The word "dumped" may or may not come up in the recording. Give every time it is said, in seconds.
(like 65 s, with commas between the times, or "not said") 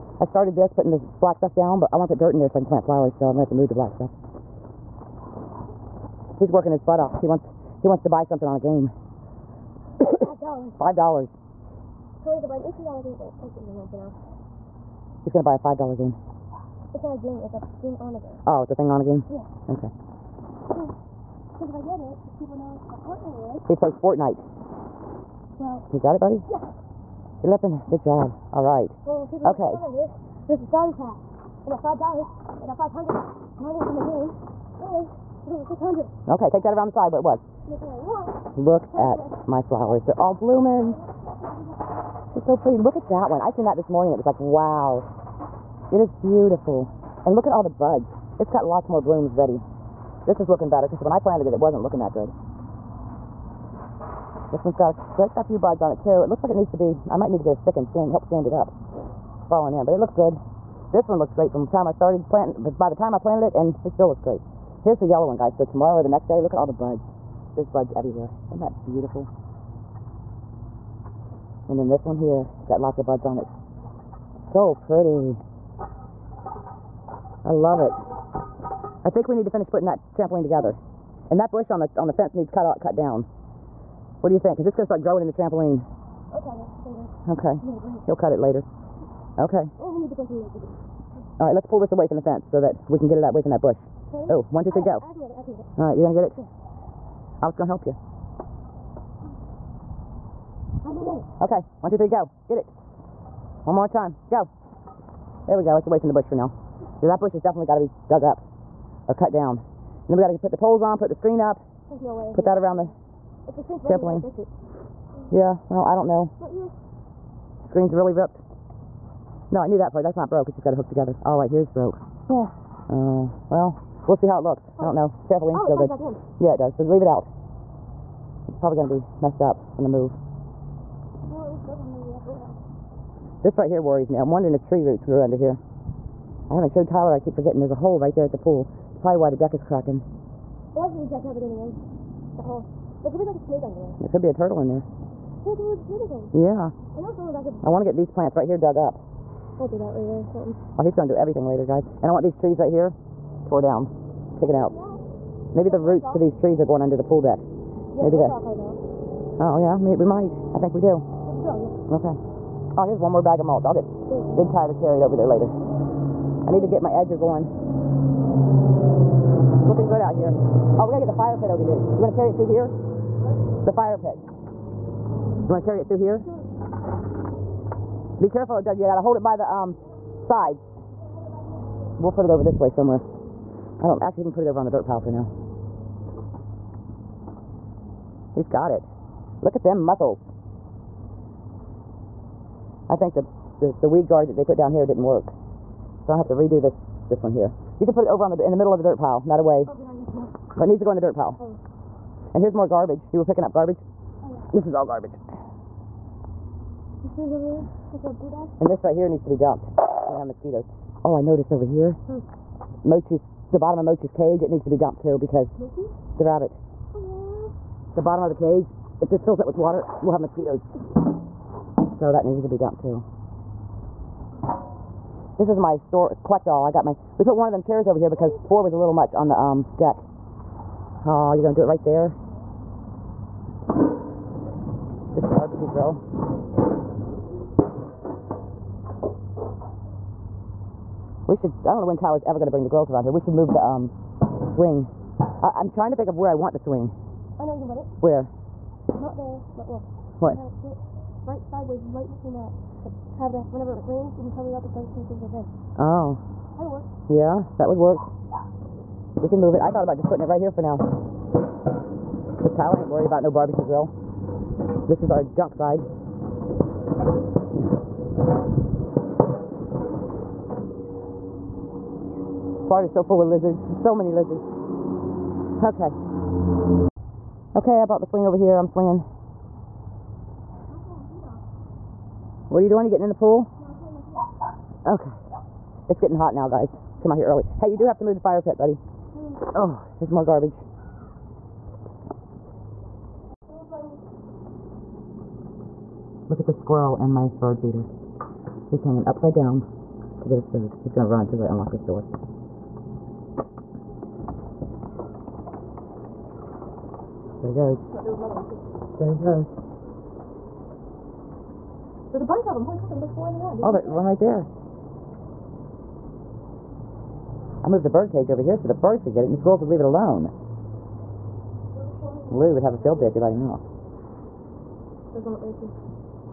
209 s, 214 s, 222 s.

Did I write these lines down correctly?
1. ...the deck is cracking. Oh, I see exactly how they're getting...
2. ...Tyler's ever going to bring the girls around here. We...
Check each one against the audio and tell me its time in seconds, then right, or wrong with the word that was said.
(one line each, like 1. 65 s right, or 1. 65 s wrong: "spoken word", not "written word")
1. 139 s right
2. 241 s right.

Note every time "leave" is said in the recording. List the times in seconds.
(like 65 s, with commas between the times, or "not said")
126 s, 319 s.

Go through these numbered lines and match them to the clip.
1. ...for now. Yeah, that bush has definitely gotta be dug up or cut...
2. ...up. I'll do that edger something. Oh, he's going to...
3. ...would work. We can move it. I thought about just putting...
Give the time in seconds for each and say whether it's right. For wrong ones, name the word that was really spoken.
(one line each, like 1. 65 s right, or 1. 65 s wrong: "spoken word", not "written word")
1. 106 s right
2. 148 s wrong: "later", not "edger"
3. 257 s right.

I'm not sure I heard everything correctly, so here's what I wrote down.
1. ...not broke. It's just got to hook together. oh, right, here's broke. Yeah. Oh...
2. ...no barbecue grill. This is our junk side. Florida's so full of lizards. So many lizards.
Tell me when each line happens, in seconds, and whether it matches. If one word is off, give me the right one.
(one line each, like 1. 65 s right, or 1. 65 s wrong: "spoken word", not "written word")
1. 120 s right
2. 263 s right.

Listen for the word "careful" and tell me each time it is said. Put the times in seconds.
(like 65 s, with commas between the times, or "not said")
178 s.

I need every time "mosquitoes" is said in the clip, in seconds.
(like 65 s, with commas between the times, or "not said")
210 s, 220 s.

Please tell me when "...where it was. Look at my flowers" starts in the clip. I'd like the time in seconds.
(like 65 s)
37 s.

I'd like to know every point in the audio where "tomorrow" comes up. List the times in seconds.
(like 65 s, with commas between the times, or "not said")
65 s.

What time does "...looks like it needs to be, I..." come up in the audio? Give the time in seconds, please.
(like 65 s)
56 s.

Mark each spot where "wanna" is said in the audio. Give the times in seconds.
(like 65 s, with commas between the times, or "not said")
1 s, 172 s.